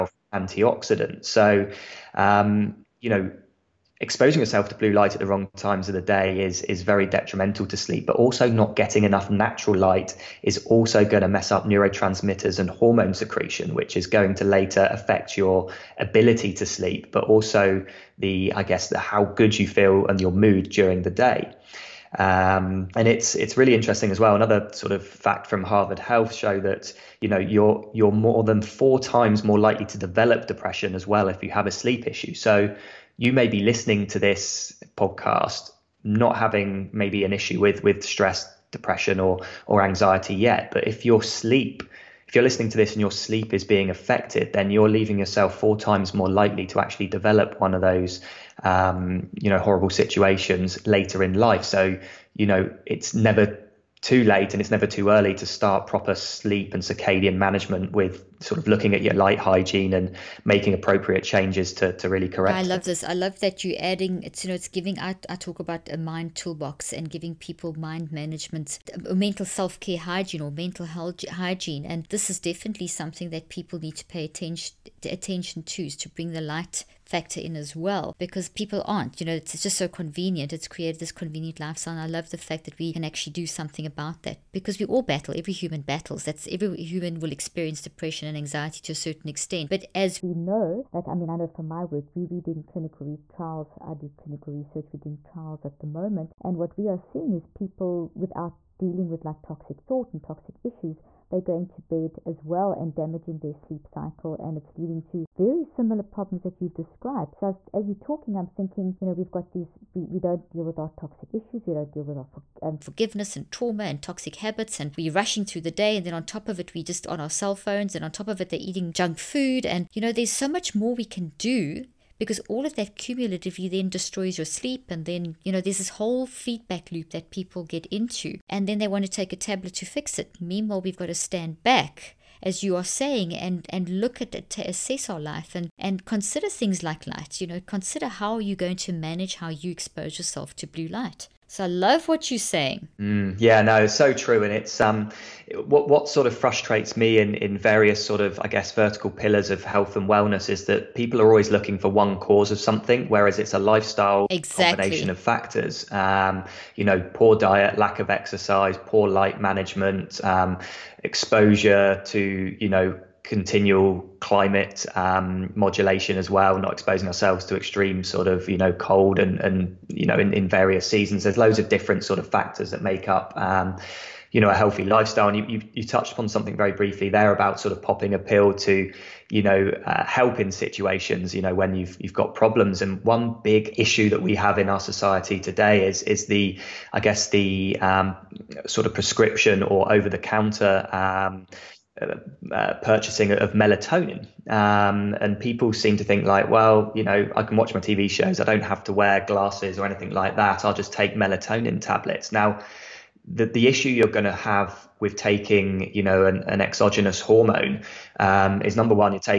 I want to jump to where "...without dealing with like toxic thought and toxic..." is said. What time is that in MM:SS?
01:38.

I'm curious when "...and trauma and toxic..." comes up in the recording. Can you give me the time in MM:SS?
01:53.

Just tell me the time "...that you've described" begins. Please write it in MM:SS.
01:46.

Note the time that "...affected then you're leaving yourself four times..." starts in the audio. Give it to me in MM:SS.
00:43.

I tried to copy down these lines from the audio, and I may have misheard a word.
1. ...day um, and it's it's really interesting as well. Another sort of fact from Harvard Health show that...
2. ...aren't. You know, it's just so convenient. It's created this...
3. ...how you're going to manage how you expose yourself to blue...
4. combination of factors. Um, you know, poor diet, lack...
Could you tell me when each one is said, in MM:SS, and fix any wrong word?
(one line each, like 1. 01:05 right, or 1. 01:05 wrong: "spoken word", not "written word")
1. 00:21 right
2. 01:18 right
3. 02:18 right
4. 02:34 right.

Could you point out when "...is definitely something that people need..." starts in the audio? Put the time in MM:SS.
01:12.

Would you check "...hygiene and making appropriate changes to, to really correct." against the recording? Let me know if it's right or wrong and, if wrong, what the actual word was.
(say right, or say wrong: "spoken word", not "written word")
right.